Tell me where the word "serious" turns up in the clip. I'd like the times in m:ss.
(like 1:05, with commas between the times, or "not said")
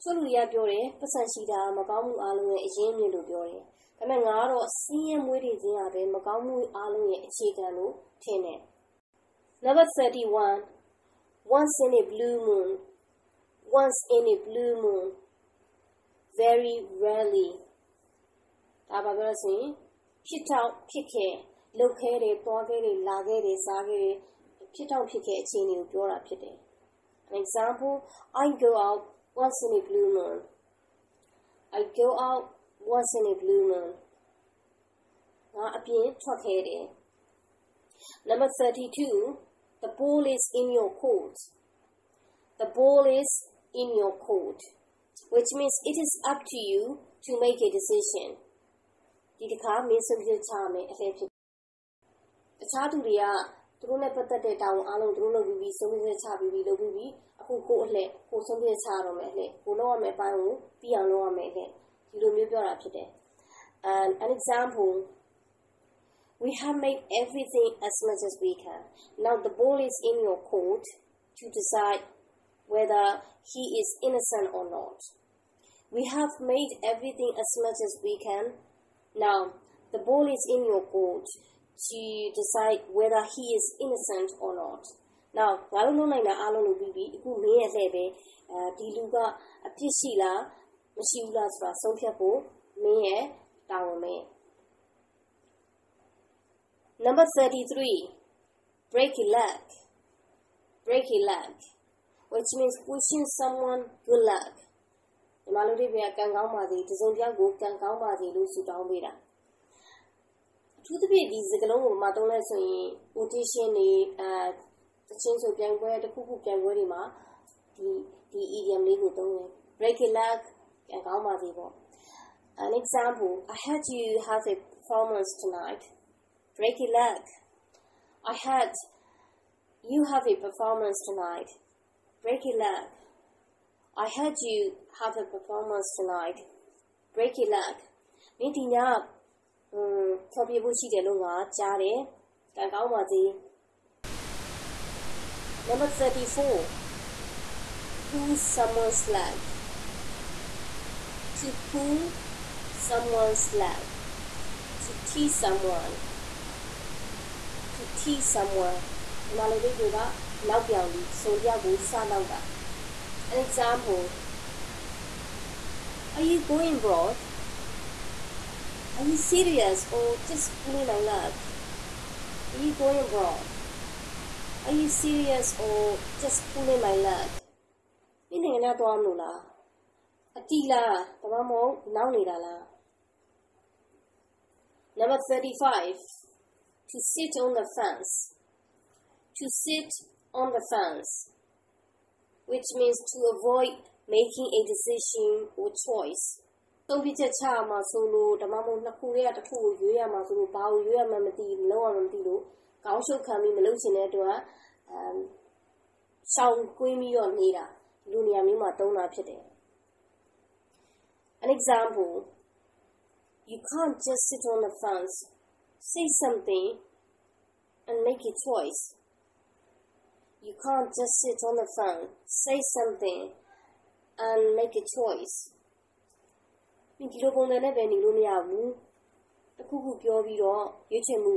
2:49, 2:55.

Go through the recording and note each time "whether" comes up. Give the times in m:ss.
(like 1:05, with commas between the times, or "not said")
1:12, 1:22.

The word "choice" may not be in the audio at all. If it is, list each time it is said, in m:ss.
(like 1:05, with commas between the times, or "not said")
3:15, 3:38, 3:44.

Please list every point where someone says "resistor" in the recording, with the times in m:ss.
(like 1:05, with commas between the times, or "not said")
not said.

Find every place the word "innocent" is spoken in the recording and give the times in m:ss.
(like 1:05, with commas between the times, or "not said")
1:13, 1:23.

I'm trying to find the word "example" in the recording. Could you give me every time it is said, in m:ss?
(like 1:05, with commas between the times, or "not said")
0:27, 1:04, 2:02, 2:43, 3:31.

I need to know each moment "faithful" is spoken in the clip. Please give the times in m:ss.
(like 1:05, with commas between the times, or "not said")
not said.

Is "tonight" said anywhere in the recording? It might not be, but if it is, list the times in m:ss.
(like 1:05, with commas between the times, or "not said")
2:05, 2:11, 2:15.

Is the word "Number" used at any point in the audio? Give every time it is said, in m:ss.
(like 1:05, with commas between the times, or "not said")
0:09, 0:38, 1:36, 2:25, 3:04.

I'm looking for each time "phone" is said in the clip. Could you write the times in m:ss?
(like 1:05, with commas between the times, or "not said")
3:41.